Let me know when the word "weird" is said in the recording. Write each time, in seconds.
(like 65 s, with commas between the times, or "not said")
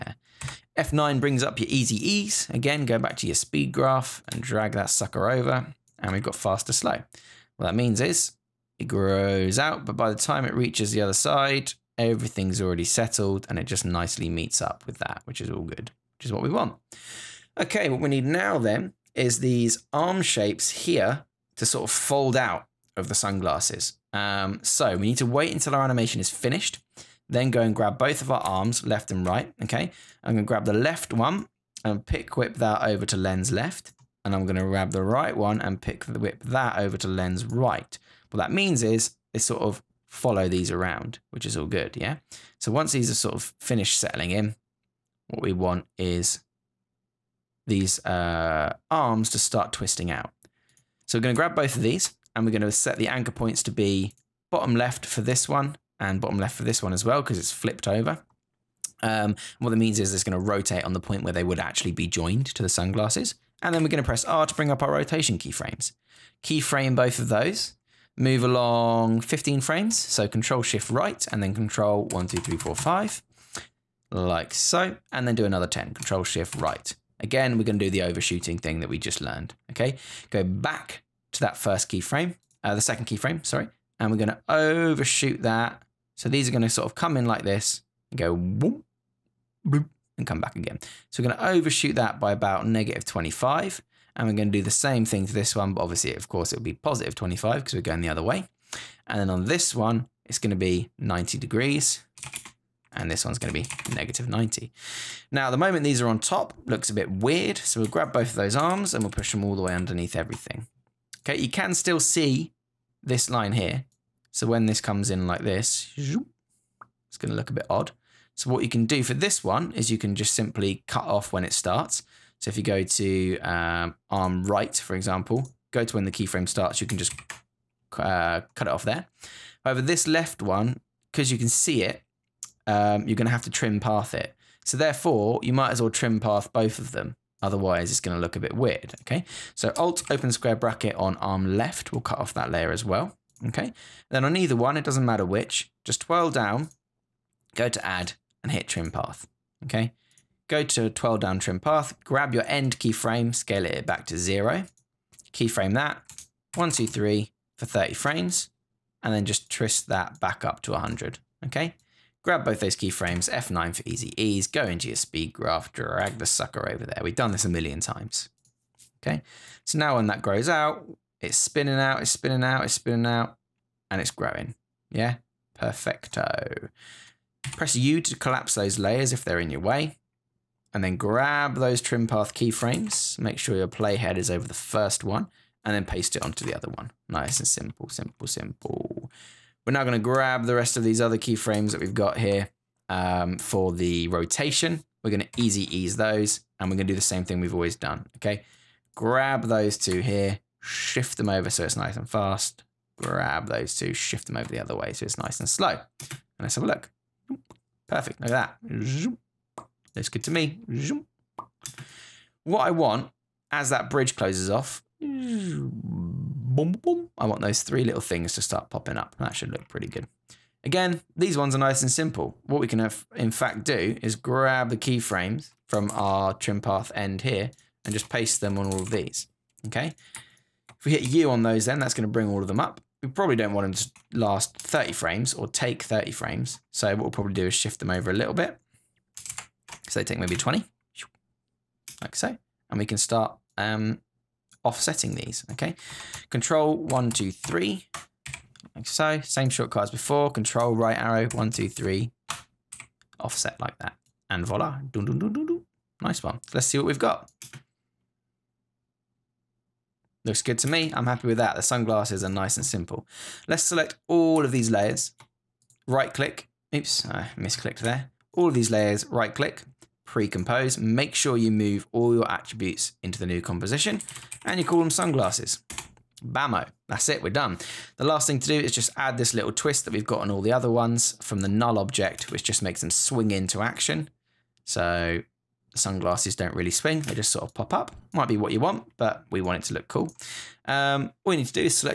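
107 s, 138 s.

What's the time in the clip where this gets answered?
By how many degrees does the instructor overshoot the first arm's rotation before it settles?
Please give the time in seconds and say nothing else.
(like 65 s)
92 s.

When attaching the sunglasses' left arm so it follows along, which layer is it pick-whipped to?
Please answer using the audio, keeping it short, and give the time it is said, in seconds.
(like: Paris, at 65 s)
lens left, at 33 s.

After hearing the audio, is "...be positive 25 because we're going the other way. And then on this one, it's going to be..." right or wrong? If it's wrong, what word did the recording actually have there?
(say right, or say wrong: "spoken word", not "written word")
right.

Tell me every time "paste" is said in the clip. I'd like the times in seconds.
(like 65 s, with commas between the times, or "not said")
185 s, 228 s.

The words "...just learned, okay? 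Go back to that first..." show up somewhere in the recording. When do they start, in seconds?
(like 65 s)
78 s.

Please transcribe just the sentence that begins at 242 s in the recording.
And we can start um, offsetting these, okay?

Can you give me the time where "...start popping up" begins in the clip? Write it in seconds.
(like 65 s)
218 s.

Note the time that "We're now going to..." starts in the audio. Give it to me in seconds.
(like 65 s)
189 s.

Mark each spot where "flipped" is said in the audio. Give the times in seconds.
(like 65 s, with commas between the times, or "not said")
57 s.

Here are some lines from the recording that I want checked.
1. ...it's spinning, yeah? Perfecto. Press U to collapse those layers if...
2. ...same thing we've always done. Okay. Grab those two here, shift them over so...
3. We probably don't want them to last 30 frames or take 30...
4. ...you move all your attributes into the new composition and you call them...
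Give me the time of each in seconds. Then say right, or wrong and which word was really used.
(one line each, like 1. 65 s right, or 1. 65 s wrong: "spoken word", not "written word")
1. 174 s wrong: "growing", not "spinning"
2. 197 s right
3. 233 s right
4. 271 s right.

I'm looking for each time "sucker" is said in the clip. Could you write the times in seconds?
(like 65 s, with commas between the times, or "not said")
4 s, 166 s.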